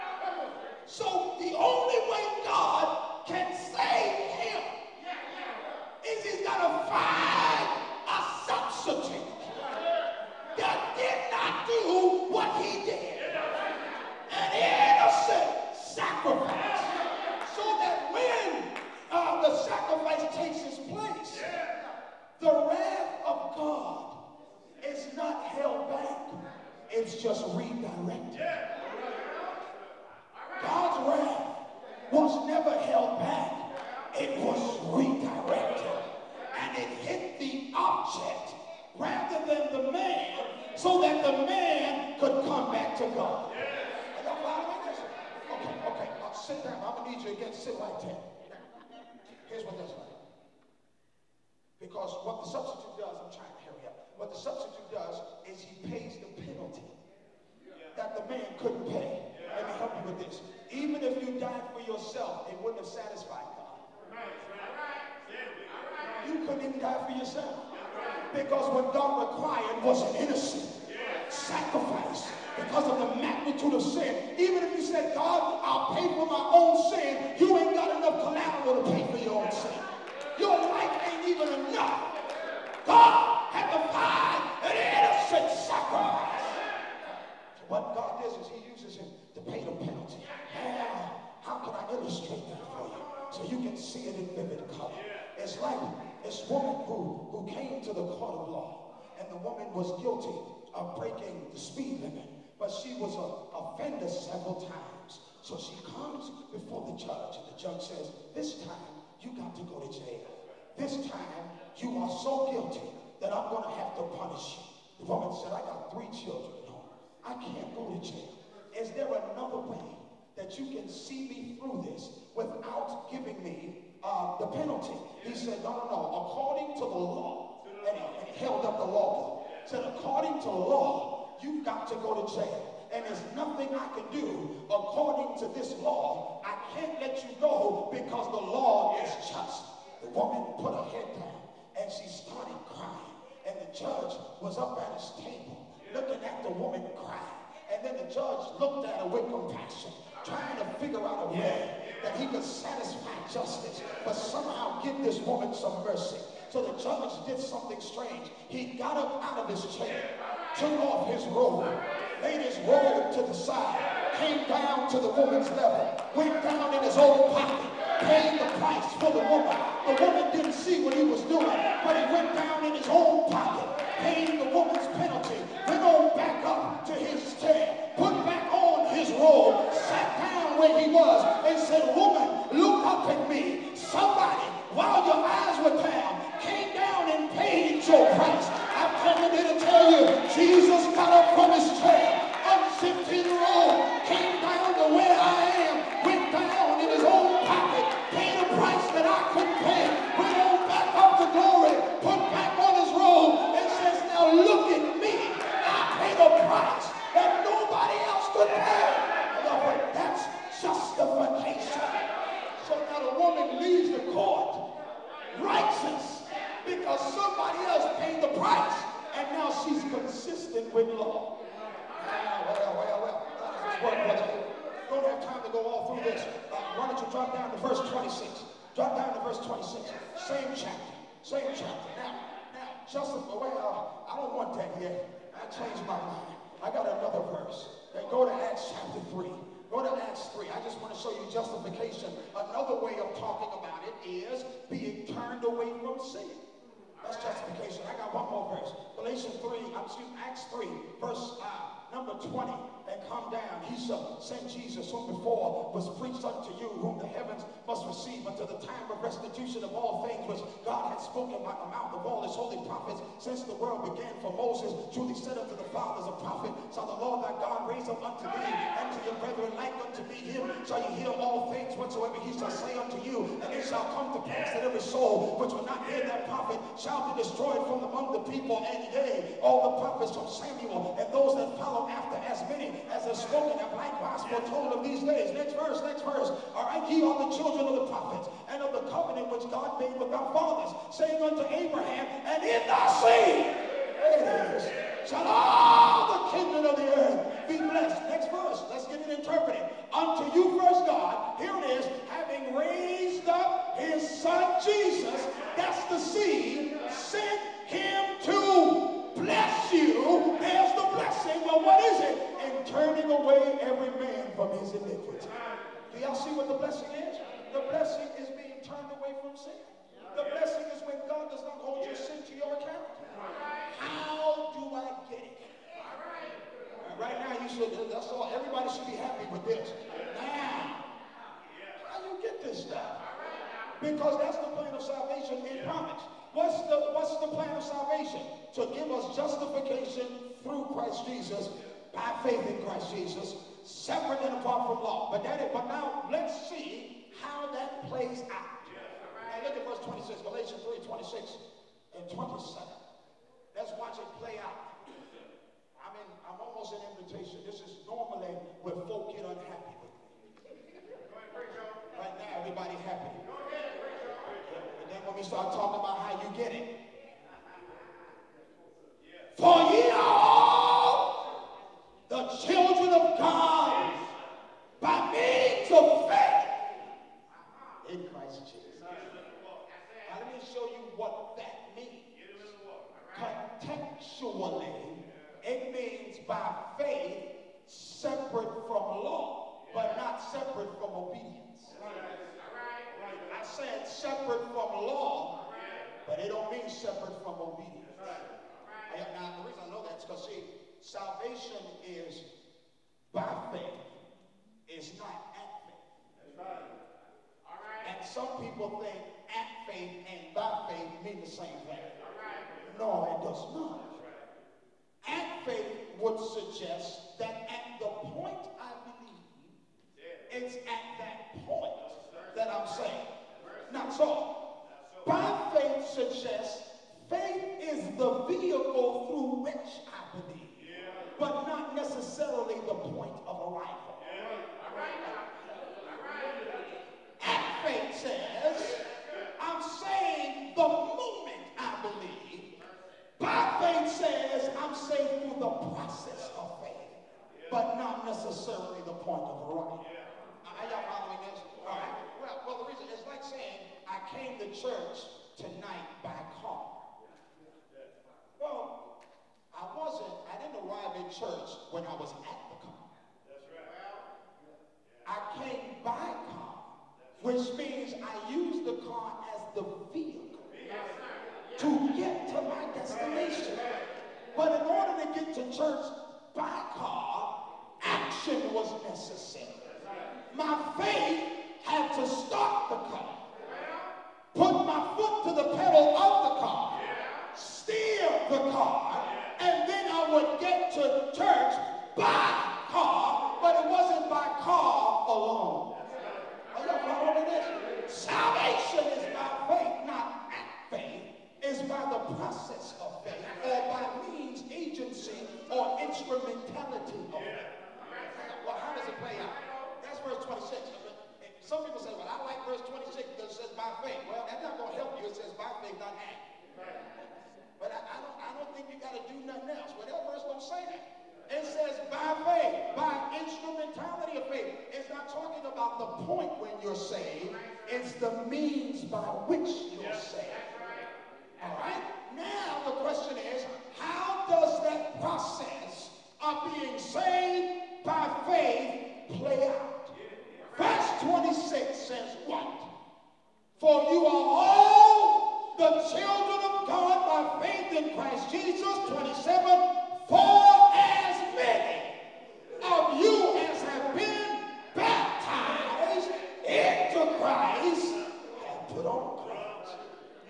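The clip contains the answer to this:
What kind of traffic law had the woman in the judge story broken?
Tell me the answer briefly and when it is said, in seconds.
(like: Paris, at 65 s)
speed limit, at 101 s.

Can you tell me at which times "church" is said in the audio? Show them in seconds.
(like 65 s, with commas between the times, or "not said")
454 s, 461 s, 475 s.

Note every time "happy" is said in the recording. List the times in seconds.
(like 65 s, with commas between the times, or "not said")
328 s.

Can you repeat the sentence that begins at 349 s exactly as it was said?
And look at verse 26, Galatians 3, 26.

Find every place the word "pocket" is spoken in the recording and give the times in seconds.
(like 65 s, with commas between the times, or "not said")
167 s, 173 s.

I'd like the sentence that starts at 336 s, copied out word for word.
What's the, what's the plan of salvation?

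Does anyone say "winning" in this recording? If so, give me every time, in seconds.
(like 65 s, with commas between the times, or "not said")
not said.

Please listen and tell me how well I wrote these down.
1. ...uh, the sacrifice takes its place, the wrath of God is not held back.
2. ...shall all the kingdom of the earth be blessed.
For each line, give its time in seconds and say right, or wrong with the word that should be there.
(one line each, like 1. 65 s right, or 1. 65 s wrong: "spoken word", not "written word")
1. 19 s right
2. 295 s right.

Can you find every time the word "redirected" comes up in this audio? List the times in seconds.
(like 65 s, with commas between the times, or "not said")
27 s, 34 s.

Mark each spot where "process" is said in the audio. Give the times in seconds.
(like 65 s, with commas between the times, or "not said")
445 s, 534 s.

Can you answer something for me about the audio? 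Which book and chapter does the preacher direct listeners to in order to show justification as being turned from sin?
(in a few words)
Acts 3.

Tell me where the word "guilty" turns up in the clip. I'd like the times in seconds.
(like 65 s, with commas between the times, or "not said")
100 s, 112 s.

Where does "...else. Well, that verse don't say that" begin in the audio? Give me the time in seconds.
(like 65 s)
519 s.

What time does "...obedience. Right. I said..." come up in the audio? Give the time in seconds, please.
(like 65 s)
390 s.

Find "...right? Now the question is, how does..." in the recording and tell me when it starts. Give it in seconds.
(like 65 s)
531 s.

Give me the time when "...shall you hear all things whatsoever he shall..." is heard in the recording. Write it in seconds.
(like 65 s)
270 s.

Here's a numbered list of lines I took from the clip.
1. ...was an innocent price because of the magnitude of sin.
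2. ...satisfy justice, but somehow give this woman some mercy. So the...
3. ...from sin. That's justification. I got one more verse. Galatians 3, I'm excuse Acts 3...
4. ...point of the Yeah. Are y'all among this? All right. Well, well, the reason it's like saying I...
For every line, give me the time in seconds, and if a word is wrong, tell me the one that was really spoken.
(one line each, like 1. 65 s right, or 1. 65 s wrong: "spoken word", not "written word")
1. 69 s wrong: "sacrifice", not "price"
2. 152 s right
3. 245 s right
4. 449 s wrong: "following", not "among".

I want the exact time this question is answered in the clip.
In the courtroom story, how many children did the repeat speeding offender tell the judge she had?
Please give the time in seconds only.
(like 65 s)
115 s.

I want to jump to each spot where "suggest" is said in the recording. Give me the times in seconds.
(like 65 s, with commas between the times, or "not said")
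416 s, 425 s.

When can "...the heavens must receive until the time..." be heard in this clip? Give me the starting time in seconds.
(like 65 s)
256 s.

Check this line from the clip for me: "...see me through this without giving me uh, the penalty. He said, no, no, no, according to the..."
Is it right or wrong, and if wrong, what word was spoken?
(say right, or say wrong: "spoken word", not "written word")
right.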